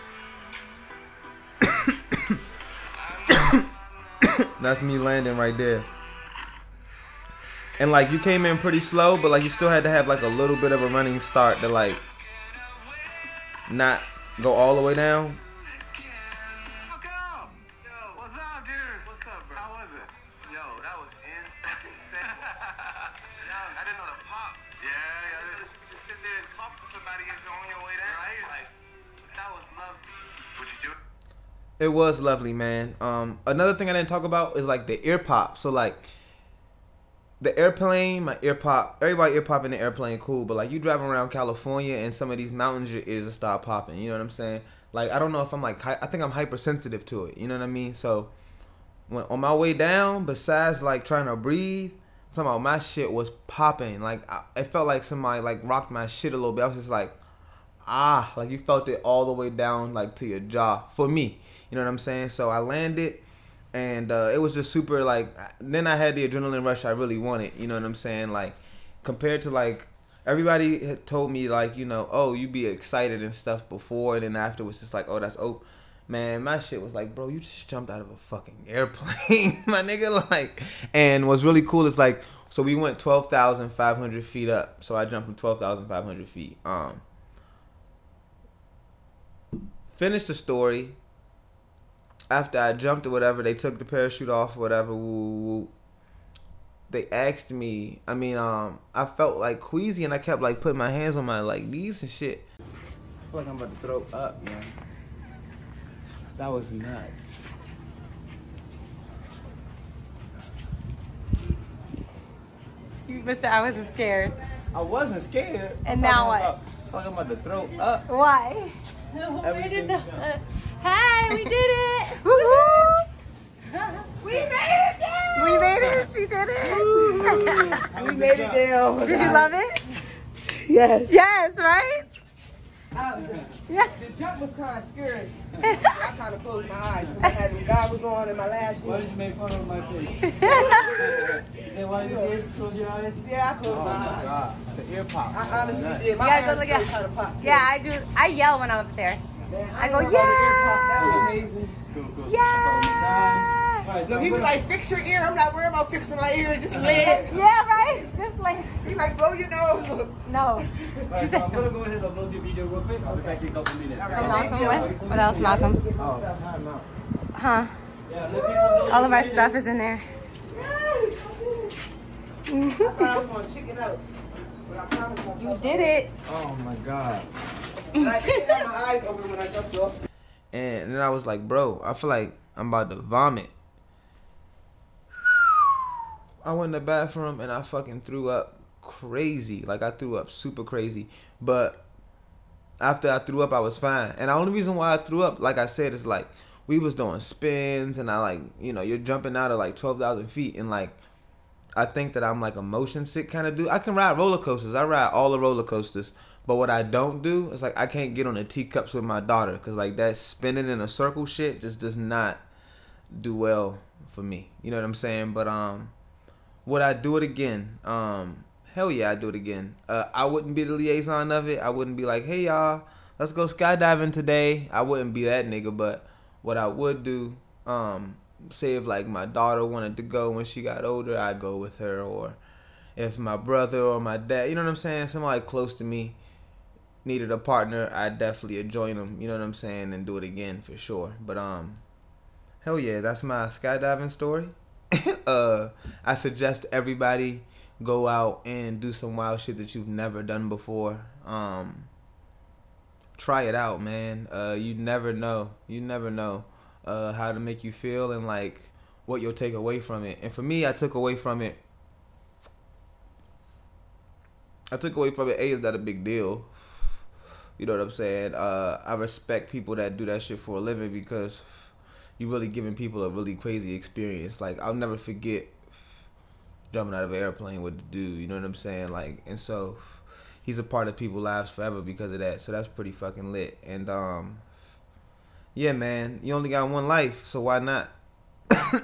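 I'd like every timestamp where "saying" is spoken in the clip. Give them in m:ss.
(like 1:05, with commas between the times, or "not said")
0:44, 1:01, 1:07, 3:34, 3:54, 3:59, 4:27, 4:38.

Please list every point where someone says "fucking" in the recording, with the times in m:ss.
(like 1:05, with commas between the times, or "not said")
1:18, 3:07, 4:42.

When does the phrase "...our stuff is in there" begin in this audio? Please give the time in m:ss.
2:49.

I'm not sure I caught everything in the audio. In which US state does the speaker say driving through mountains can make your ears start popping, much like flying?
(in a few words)
California.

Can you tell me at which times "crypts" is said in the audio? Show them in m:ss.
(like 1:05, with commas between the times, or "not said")
not said.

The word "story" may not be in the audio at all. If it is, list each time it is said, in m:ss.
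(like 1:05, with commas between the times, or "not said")
1:30, 4:04.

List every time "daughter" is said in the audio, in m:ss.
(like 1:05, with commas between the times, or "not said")
3:29, 3:49.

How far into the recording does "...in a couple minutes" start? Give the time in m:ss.
2:43.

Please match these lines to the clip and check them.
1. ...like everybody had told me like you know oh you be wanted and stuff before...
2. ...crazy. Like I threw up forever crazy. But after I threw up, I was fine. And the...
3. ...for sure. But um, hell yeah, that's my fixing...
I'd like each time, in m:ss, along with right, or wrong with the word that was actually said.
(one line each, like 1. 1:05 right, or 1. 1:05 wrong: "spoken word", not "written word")
1. 1:09 wrong: "excited", not "wanted"
2. 3:08 wrong: "super", not "forever"
3. 4:00 wrong: "skydiving", not "fixing".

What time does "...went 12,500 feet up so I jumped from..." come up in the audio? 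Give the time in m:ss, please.
1:22.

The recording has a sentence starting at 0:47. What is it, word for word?
So when on my way down, besides like trying to breathe, I'm talking about my shit was popping.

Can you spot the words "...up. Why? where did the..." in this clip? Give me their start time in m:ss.
1:57.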